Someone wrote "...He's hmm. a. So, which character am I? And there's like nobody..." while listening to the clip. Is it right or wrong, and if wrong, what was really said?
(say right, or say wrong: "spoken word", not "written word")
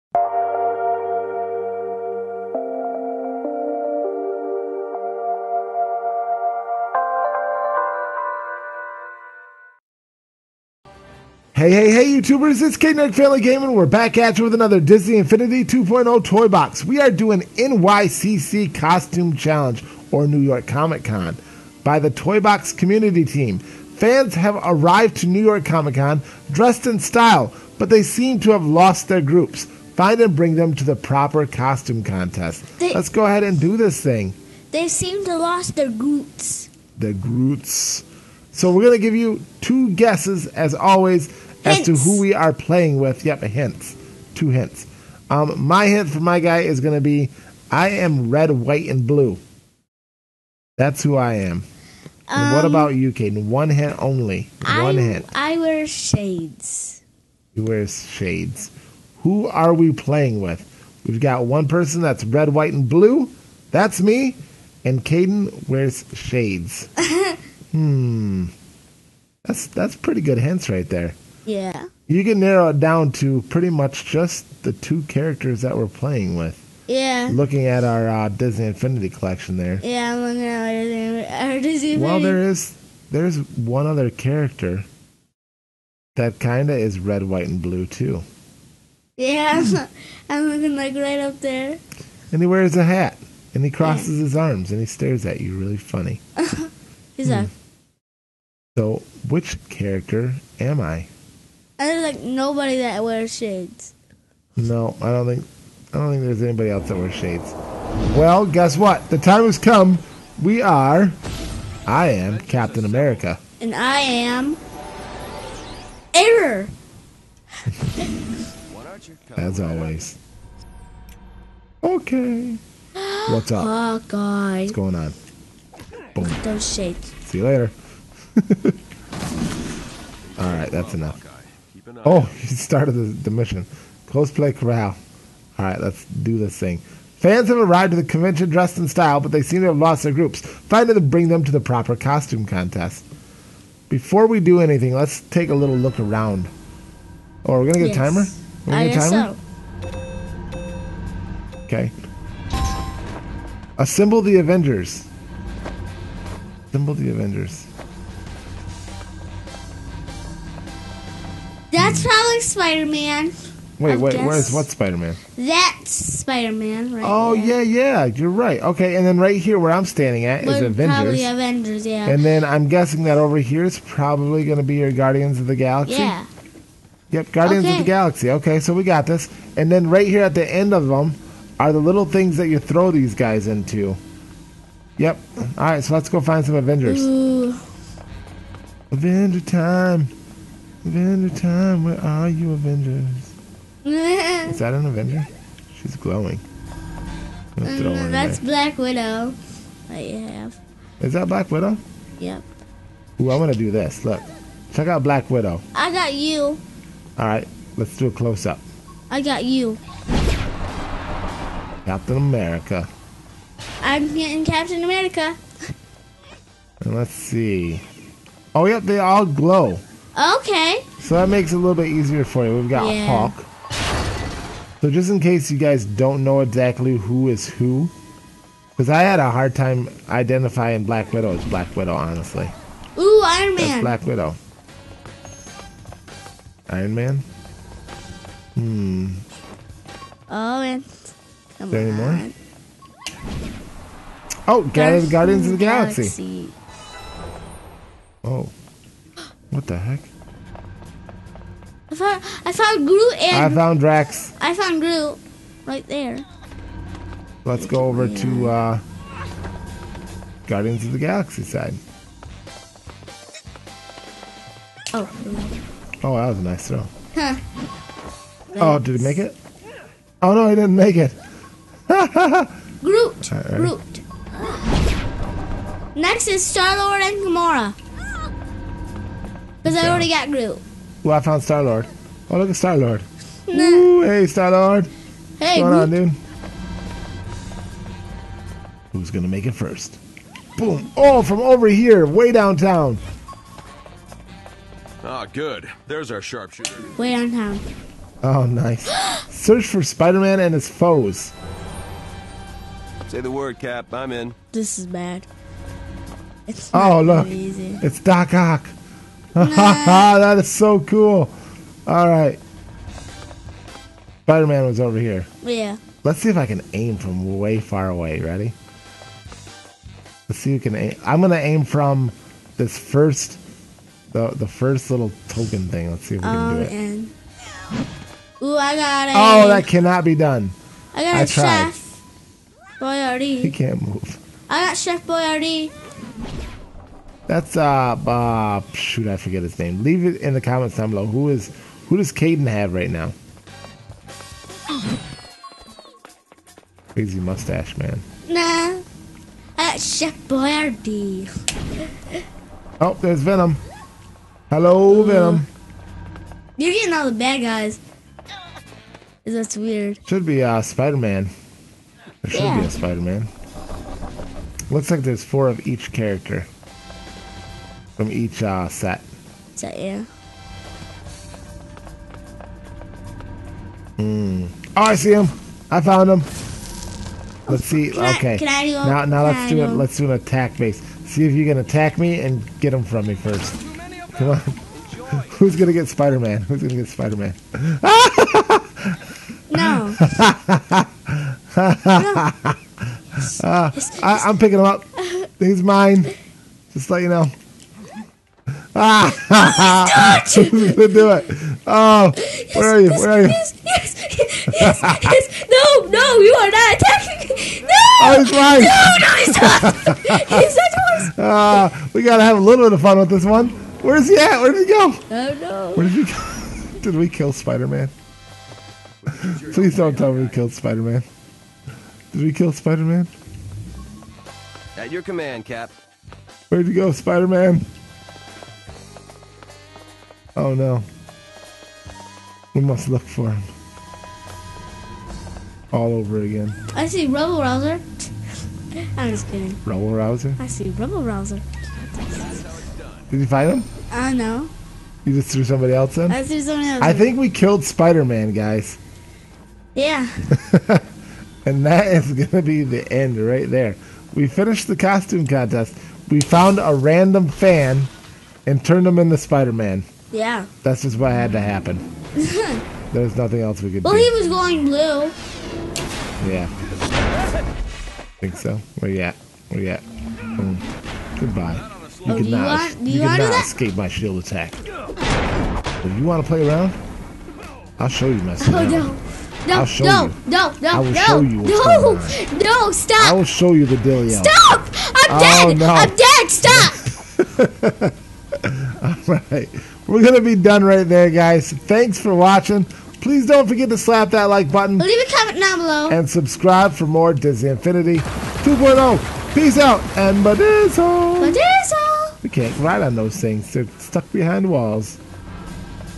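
right.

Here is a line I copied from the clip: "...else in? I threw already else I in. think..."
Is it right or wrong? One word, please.
wrong.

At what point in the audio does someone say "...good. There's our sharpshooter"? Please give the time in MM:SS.
04:55.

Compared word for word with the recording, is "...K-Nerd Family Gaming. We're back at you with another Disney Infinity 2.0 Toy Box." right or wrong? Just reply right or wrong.
right.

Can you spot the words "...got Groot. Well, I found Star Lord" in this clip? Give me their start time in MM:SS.
04:40.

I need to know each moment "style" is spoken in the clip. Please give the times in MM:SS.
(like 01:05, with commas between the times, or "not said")
00:26, 02:18.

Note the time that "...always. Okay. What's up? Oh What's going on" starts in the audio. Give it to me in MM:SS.
01:59.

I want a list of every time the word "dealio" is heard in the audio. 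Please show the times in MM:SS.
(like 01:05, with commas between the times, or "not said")
08:03.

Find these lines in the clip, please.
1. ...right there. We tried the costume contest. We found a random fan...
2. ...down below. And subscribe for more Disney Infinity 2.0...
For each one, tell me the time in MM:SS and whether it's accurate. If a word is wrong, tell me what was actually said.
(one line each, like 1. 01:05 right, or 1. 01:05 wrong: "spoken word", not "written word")
1. 07:33 wrong: "finished", not "tried"
2. 08:15 right.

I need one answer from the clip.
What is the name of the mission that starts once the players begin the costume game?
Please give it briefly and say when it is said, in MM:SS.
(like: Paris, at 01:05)
Cosplay Corral, at 02:14.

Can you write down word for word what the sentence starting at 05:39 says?
Leave it in the comments down below.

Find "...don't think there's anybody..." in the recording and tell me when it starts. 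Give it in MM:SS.
01:45.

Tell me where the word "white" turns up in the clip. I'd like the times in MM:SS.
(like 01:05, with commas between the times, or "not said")
00:48, 01:02, 01:27.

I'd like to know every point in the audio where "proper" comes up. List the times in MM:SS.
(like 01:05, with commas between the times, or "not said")
00:30, 02:21.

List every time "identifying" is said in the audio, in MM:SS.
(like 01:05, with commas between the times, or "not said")
03:50.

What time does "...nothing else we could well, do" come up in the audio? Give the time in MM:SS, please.
07:43.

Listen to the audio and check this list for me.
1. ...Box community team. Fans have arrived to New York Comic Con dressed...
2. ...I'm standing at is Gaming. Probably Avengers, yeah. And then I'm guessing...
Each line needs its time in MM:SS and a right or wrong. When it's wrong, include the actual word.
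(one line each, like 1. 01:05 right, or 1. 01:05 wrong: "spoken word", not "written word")
1. 00:22 right
2. 02:49 wrong: "Avengers", not "Gaming".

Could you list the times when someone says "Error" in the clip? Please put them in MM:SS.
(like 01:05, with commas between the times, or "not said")
01:56.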